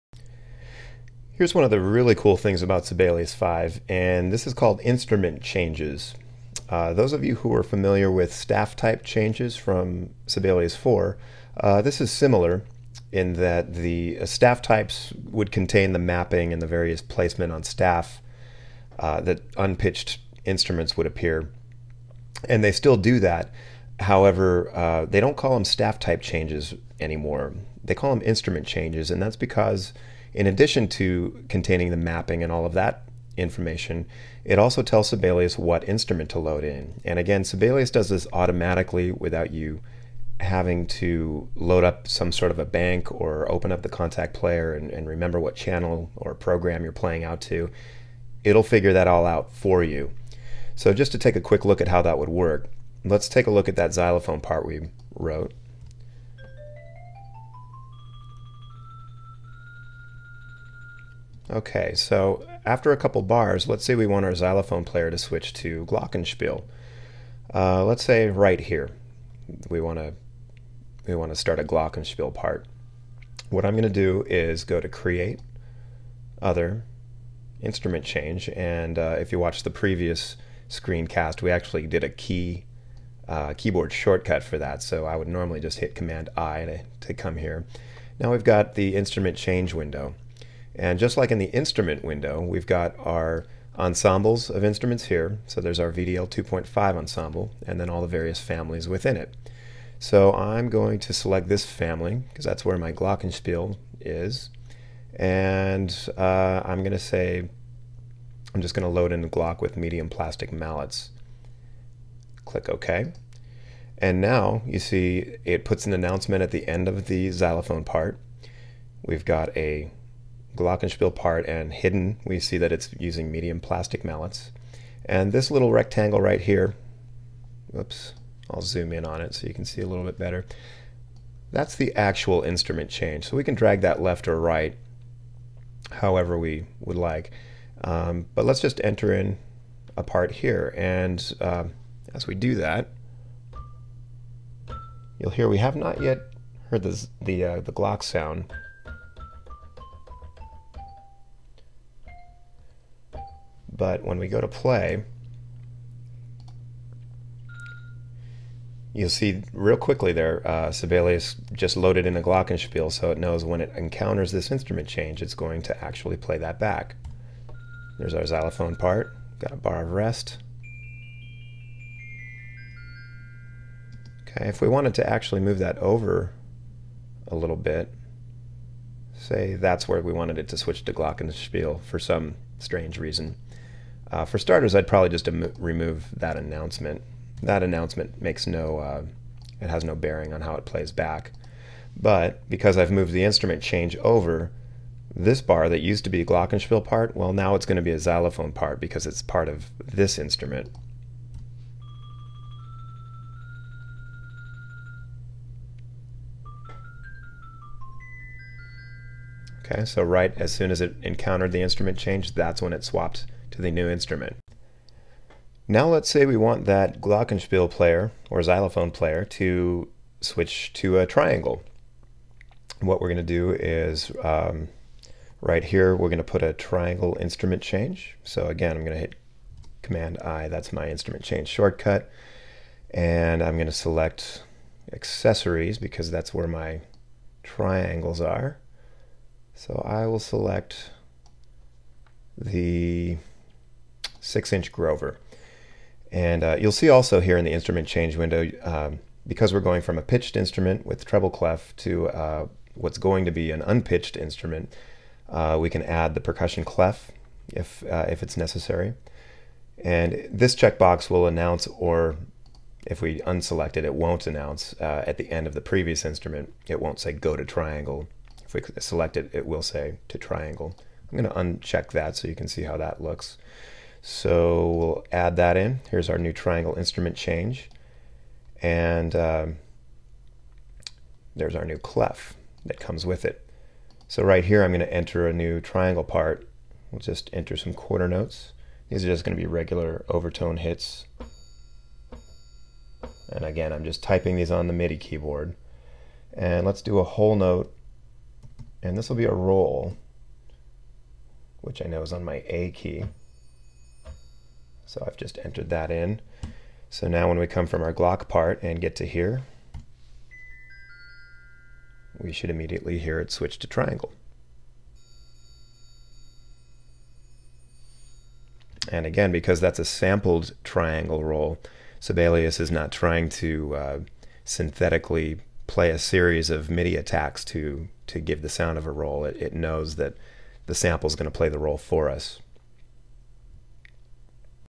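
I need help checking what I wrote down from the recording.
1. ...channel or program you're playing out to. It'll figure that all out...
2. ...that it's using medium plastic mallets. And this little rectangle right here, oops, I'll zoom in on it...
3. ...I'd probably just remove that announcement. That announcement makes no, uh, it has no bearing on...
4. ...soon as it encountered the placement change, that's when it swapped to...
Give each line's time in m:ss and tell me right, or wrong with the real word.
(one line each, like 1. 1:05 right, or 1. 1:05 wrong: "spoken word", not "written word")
1. 0:45 right
2. 2:02 right
3. 3:04 right
4. 3:30 wrong: "instrument", not "placement".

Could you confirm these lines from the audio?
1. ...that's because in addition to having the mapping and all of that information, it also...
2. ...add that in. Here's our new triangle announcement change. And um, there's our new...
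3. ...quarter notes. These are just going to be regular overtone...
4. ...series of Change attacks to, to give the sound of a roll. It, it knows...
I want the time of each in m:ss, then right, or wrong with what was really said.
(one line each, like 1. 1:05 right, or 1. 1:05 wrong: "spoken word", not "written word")
1. 0:29 wrong: "containing", not "having"
2. 4:35 wrong: "instrument", not "announcement"
3. 4:47 right
4. 5:25 wrong: "MIDI", not "Change".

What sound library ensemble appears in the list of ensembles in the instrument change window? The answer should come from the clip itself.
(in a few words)
VDL 2.5.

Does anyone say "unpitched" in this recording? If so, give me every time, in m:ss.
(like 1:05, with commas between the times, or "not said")
0:19, 4:13.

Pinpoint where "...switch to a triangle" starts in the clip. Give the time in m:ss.
3:40.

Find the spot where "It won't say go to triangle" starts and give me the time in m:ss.
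4:26.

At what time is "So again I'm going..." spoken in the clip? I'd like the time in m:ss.
3:48.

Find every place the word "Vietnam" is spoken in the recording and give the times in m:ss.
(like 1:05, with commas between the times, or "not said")
not said.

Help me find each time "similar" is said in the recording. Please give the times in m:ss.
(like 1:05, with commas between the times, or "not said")
0:12.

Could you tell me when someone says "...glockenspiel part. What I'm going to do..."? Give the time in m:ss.
1:11.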